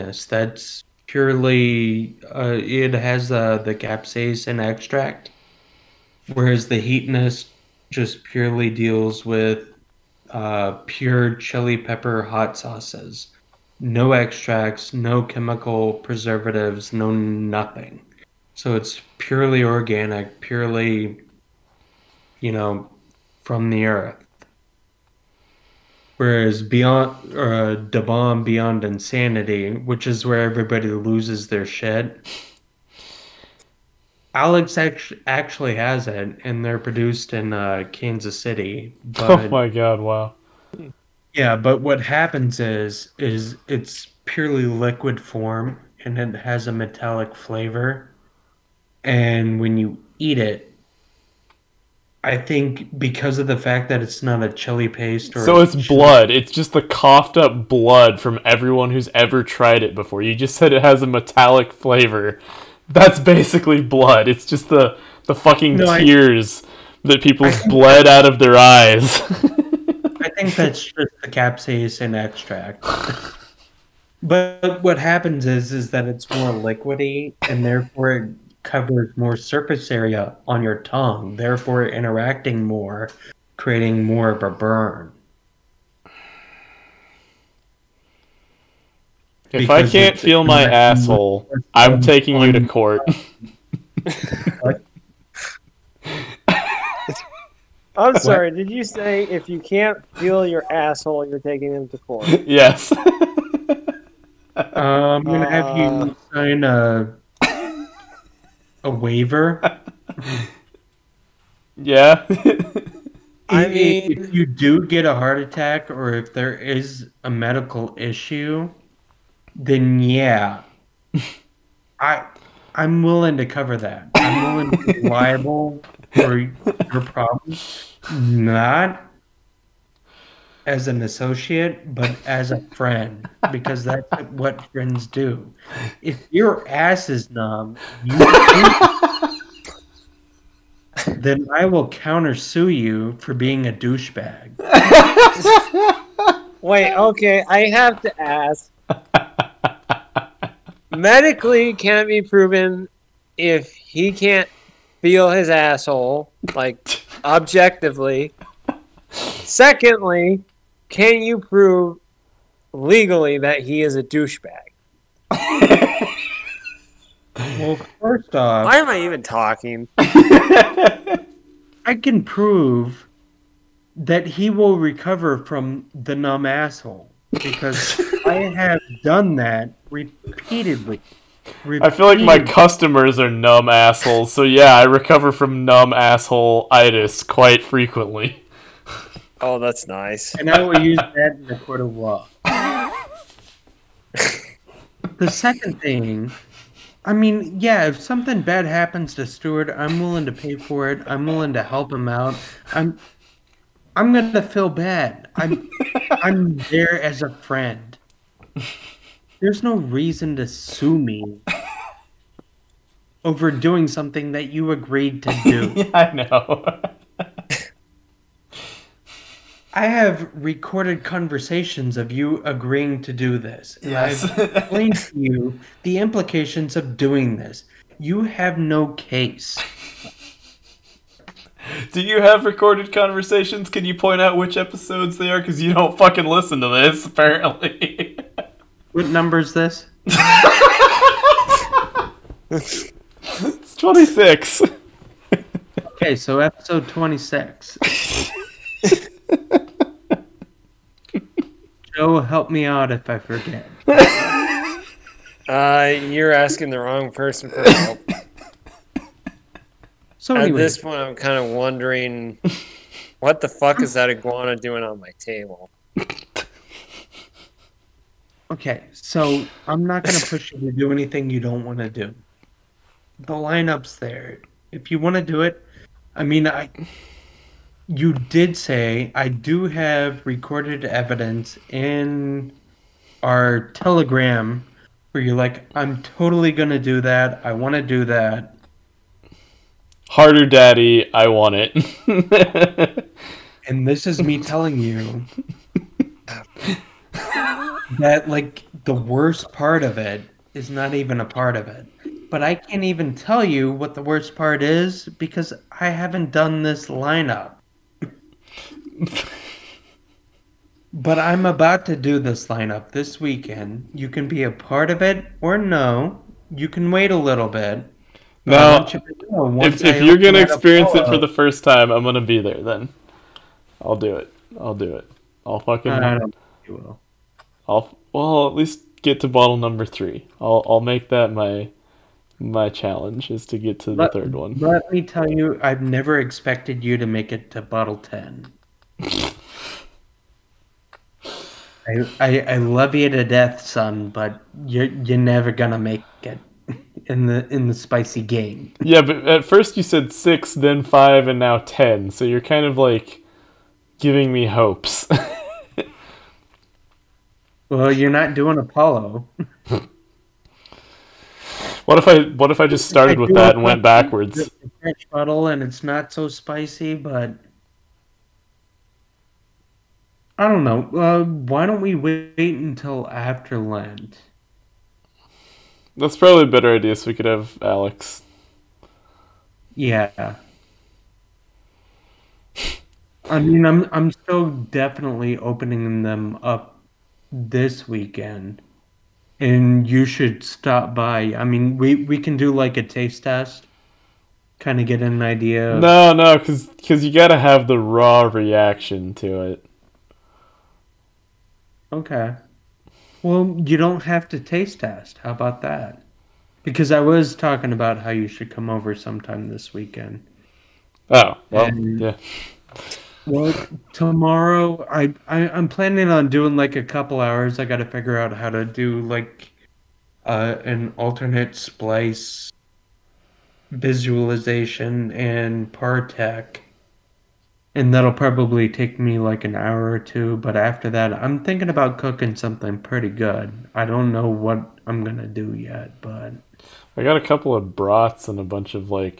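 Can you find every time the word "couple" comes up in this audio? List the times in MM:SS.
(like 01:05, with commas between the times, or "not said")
06:56, 07:17.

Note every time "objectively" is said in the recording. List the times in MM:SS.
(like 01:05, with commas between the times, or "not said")
02:37.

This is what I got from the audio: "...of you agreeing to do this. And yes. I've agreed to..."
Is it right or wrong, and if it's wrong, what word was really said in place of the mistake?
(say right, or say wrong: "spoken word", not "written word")
wrong: "explained", not "agreed".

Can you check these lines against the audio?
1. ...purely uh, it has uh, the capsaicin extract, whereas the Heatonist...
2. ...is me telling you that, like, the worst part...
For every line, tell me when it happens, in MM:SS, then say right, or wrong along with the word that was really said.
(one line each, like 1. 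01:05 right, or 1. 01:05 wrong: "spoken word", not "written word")
1. 00:01 right
2. 04:54 right.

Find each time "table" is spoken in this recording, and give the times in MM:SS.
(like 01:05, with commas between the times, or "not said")
04:25.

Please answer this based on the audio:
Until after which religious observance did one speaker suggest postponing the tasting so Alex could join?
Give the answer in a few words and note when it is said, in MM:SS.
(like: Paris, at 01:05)
Lent, at 06:13.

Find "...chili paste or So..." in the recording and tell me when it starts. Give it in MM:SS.
00:54.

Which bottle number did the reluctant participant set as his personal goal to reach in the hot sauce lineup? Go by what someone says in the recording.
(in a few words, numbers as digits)
3.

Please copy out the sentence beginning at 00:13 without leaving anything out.
No extracts, no chemical preservatives, no nothing.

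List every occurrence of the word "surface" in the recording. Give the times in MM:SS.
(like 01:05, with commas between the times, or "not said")
01:19.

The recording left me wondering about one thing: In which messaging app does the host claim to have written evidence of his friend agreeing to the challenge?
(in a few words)
Telegram.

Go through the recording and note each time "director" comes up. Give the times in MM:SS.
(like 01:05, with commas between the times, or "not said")
not said.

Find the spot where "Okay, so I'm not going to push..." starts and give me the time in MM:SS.
04:28.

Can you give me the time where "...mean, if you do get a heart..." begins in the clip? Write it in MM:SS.
01:53.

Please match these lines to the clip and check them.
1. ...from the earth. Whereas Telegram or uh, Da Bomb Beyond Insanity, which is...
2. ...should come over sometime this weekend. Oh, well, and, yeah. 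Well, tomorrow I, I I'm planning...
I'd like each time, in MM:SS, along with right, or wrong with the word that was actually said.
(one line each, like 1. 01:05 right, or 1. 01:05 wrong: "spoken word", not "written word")
1. 00:23 wrong: "Beyond", not "Telegram"
2. 06:48 right.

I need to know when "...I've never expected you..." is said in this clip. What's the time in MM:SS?
05:35.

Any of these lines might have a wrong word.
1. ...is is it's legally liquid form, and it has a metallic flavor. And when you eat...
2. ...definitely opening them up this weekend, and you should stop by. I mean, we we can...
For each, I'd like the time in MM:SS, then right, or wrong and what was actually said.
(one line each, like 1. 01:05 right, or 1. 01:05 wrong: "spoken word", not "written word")
1. 00:42 wrong: "purely", not "legally"
2. 06:24 right.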